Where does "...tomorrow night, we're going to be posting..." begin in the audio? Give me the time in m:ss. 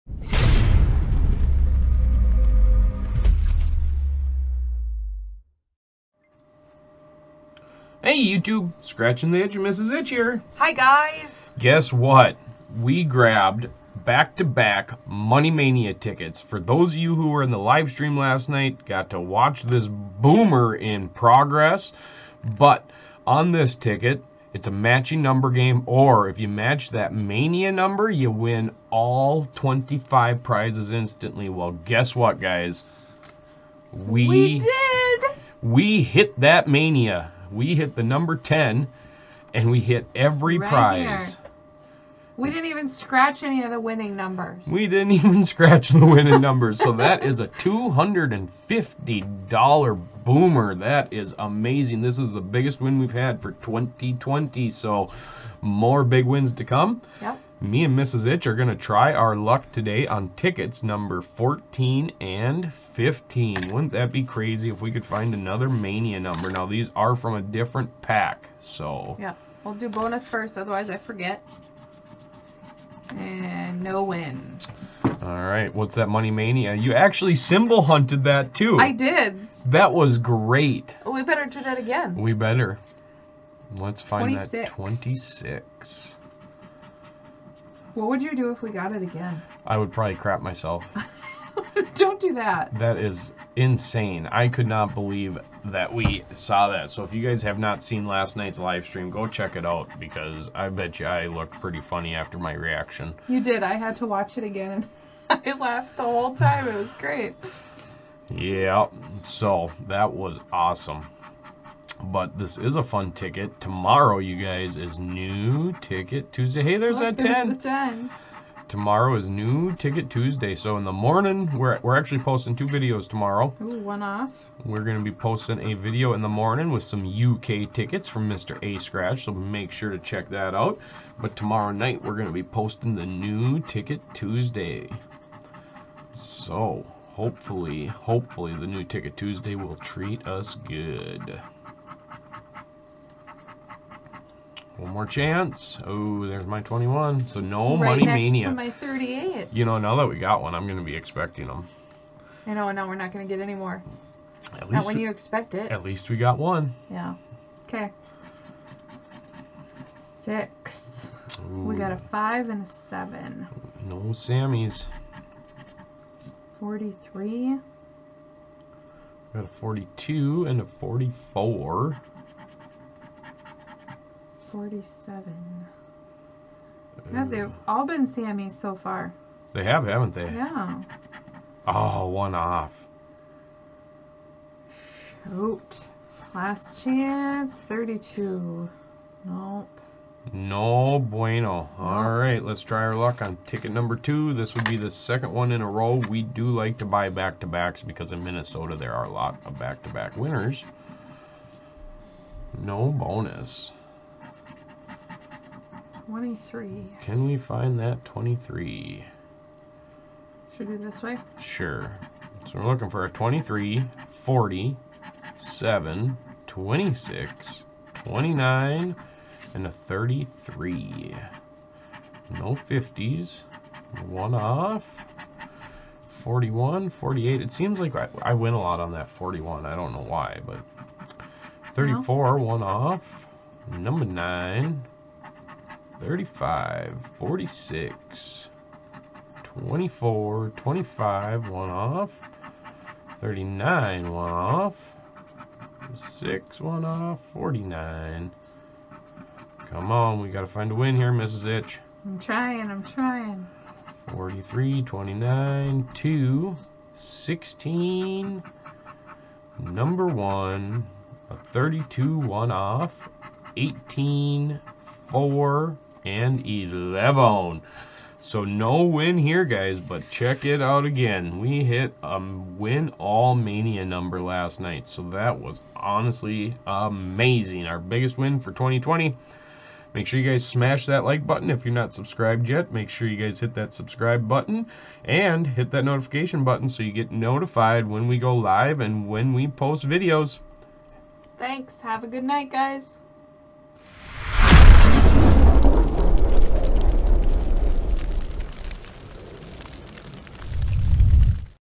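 2:11.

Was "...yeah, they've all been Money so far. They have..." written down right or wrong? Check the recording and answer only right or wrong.
wrong.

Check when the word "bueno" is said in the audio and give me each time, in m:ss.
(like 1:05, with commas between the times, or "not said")
3:10.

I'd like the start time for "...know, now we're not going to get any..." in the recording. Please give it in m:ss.
2:32.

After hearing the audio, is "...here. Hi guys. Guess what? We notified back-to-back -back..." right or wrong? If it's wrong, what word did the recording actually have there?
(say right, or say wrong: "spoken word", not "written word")
wrong: "grabbed", not "notified".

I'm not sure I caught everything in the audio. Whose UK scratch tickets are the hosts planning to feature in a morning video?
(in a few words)
Mr. A Scratch.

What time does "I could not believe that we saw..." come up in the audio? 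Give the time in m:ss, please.
1:34.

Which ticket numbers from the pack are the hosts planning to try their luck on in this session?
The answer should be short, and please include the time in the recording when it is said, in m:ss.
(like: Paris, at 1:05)
14 and 15, at 1:01.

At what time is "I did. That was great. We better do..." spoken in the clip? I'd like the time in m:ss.
1:18.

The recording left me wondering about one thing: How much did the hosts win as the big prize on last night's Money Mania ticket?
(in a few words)
$250.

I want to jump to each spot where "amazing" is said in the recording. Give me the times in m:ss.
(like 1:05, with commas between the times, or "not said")
0:51, 4:36.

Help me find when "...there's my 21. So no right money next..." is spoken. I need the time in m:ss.
2:26.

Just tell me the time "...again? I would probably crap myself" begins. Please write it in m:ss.
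1:29.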